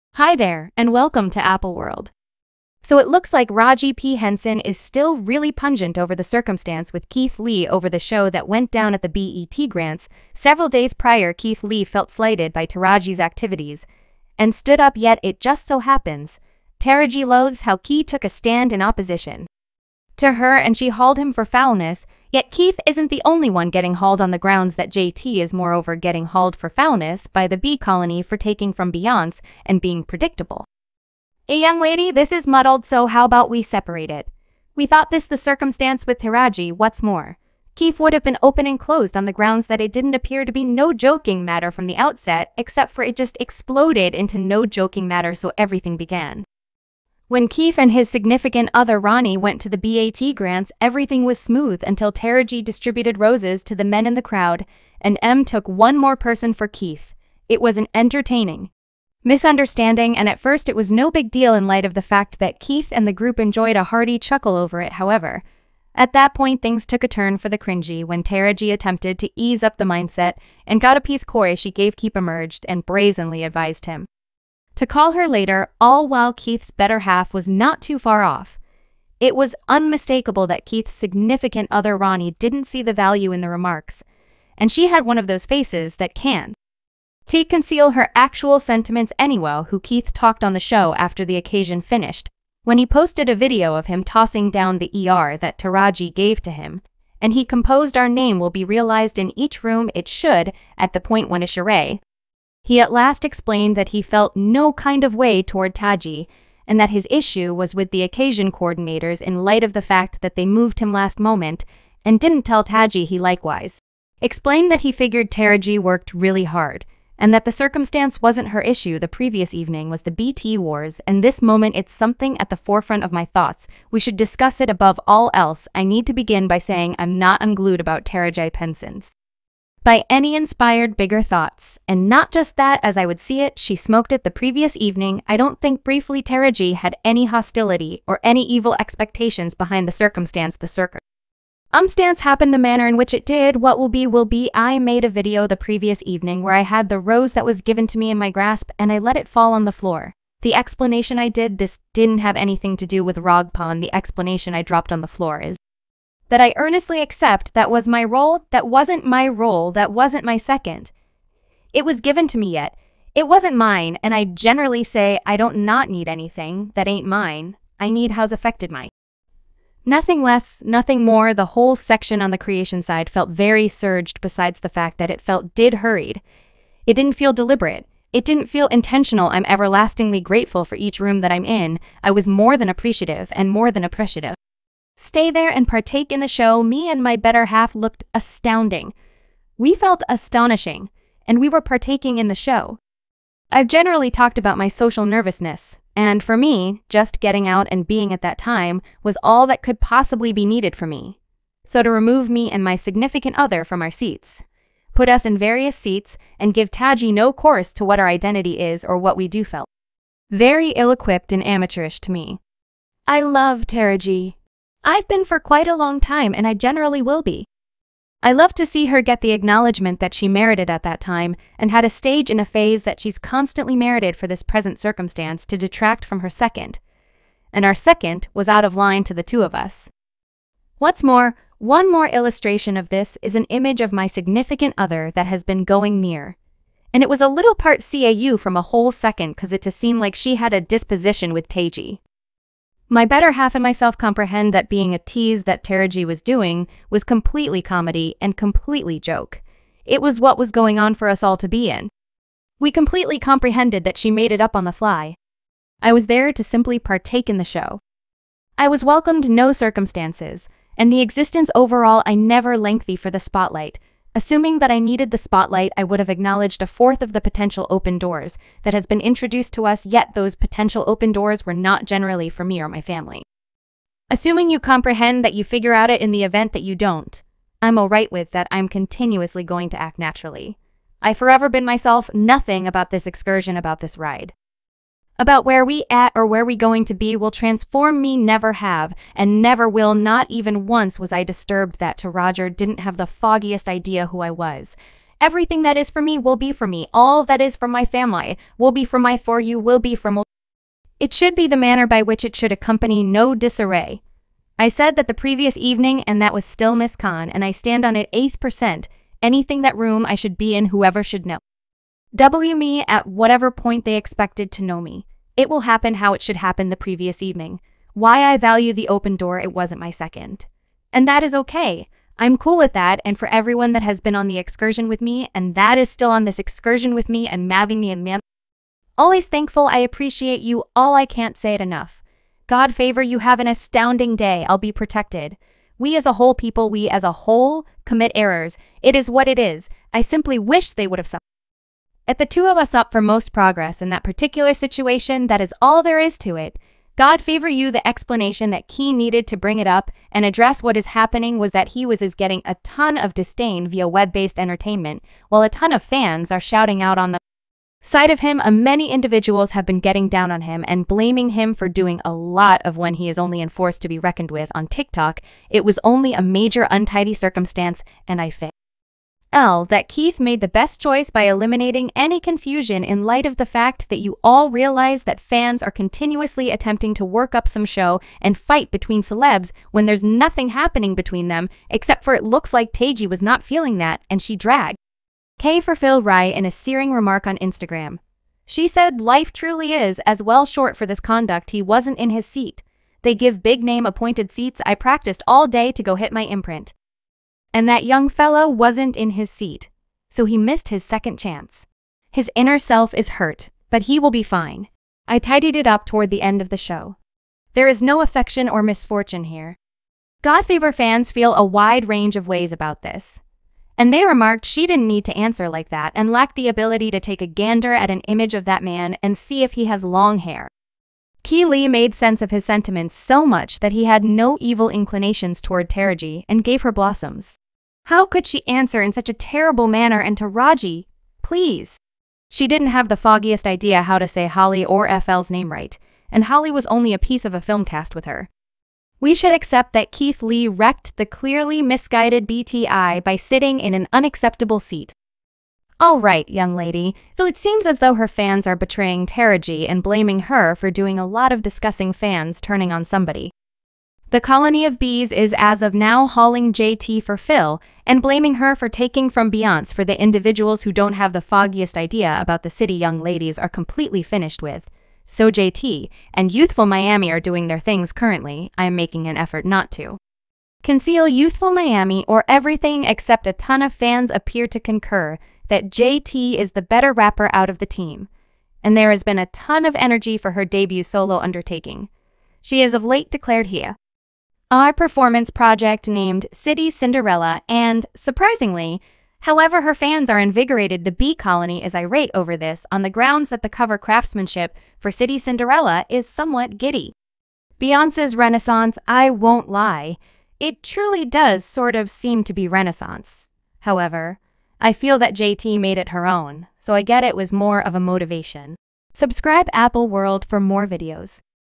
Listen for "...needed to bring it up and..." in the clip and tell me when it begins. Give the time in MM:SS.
05:48.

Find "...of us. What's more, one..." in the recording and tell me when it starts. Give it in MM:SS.
03:49.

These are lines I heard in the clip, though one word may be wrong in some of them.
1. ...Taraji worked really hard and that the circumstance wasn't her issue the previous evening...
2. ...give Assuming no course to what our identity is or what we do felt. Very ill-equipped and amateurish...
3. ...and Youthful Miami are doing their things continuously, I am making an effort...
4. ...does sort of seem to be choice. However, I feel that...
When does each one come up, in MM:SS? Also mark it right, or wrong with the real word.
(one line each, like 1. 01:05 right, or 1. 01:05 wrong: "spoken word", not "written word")
1. 01:55 right
2. 03:26 wrong: "Taji", not "Assuming"
3. 07:46 wrong: "currently", not "continuously"
4. 08:21 wrong: "renaissance", not "choice".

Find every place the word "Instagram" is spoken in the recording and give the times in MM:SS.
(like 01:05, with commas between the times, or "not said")
06:27.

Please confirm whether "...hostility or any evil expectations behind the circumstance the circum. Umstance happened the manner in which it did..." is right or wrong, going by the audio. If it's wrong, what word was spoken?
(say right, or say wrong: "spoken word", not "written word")
right.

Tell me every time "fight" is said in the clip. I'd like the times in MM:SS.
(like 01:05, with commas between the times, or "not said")
06:18.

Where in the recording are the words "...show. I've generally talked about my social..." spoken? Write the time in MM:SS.
03:12.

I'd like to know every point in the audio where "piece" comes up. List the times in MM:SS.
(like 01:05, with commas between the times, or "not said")
01:11, 07:16.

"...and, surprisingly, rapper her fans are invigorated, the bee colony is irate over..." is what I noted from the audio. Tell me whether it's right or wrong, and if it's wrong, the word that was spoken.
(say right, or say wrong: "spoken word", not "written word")
wrong: "however", not "rapper".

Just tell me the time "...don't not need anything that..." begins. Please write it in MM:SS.
02:45.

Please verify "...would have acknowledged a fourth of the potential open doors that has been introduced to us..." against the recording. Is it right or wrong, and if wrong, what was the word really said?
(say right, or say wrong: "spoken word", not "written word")
right.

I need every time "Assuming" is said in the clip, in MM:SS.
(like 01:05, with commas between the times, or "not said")
04:24, 04:34.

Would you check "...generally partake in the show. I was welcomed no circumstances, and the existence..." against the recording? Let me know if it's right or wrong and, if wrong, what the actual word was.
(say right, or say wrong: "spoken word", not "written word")
wrong: "simply", not "generally".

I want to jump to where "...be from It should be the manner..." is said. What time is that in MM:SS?
04:59.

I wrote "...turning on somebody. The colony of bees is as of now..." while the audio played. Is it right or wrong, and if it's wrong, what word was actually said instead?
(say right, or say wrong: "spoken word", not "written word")
right.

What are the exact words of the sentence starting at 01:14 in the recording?
To call her later, all while Keith's better half was not too far off.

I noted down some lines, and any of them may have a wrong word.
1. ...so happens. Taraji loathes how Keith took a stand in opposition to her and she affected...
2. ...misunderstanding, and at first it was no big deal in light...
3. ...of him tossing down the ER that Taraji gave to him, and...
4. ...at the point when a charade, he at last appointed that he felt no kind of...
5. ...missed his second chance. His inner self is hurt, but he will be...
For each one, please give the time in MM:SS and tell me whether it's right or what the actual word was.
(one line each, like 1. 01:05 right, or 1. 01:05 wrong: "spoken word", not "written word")
1. 00:15 wrong: "hauled", not "affected"
2. 00:59 right
3. 01:33 right
4. 01:40 wrong: "explained", not "appointed"
5. 06:40 right.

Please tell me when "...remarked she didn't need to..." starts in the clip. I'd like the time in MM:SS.
06:54.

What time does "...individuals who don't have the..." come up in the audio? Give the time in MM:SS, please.
07:39.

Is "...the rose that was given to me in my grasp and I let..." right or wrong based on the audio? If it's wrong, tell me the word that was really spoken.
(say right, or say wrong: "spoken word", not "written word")
right.